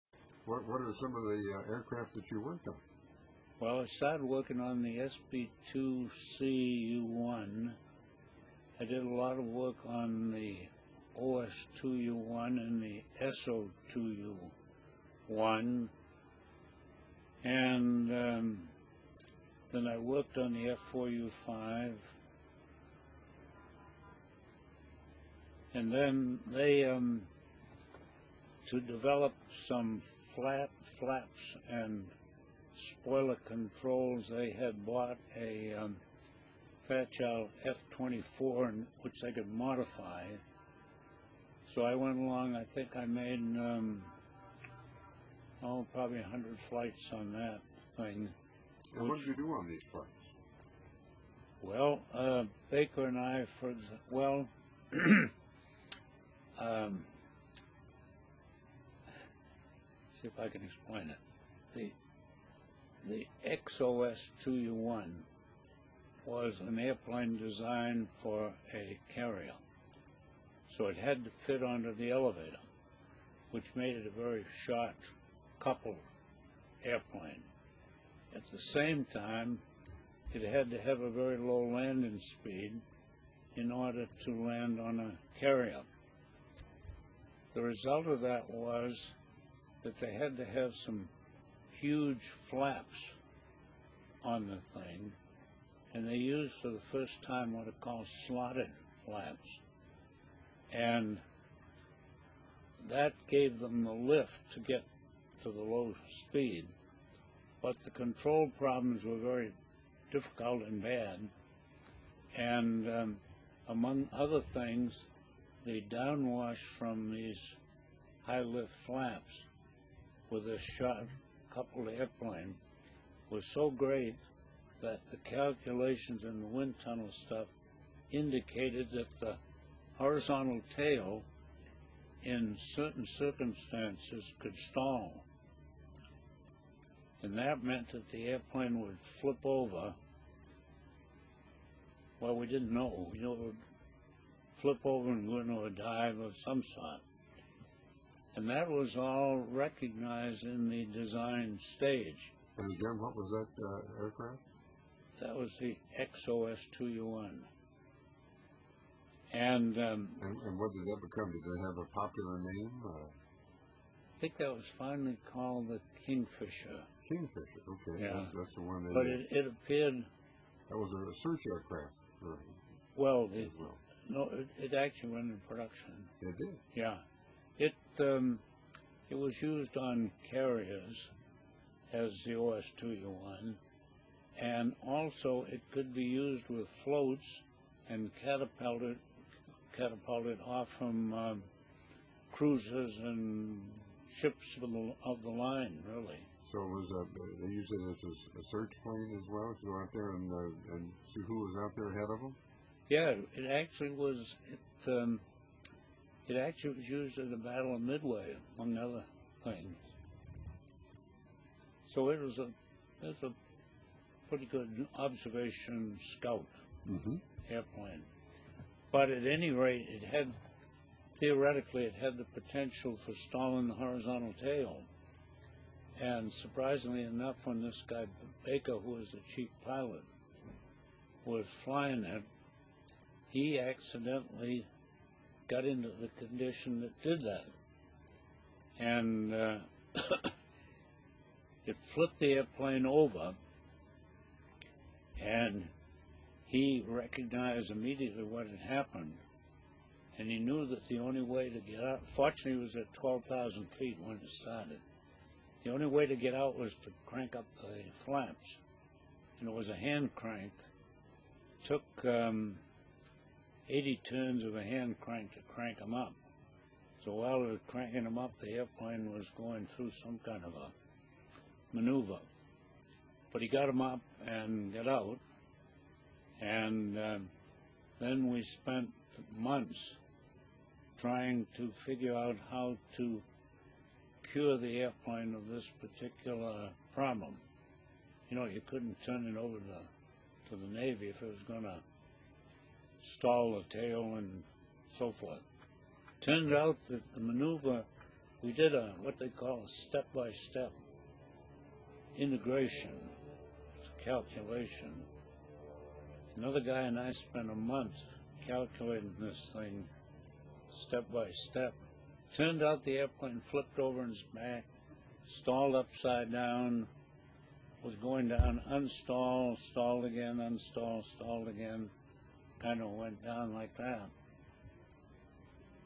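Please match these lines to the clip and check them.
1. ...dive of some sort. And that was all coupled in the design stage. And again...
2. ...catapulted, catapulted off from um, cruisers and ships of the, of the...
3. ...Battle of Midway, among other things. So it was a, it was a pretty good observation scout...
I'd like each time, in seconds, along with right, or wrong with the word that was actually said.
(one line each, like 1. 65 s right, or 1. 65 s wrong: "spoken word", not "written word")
1. 145 s wrong: "recognized", not "coupled"
2. 188 s right
3. 207 s right.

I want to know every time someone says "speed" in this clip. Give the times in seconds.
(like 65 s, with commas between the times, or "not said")
82 s, 106 s.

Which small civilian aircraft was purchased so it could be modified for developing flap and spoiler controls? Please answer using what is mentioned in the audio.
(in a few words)
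Fairchild F-24.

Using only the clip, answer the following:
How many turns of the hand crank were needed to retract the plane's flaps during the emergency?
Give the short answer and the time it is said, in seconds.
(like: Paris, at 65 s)
80, at 263 s.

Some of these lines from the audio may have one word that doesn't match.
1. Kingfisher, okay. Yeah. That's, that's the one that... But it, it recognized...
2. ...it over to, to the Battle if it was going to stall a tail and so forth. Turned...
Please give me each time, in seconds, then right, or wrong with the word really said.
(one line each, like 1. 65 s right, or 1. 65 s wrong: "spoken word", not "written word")
1. 167 s wrong: "appeared", not "recognized"
2. 289 s wrong: "Navy", not "Battle".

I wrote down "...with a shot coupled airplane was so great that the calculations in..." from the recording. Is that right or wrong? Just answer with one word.
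right.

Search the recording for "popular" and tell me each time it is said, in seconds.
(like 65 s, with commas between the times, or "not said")
161 s.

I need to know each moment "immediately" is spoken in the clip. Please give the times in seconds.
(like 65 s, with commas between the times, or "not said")
247 s.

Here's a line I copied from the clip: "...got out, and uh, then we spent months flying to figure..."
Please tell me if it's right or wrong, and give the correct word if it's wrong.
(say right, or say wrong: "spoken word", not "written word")
wrong: "trying", not "flying".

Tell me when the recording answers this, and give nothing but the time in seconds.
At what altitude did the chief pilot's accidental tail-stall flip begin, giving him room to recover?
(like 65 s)
252 s.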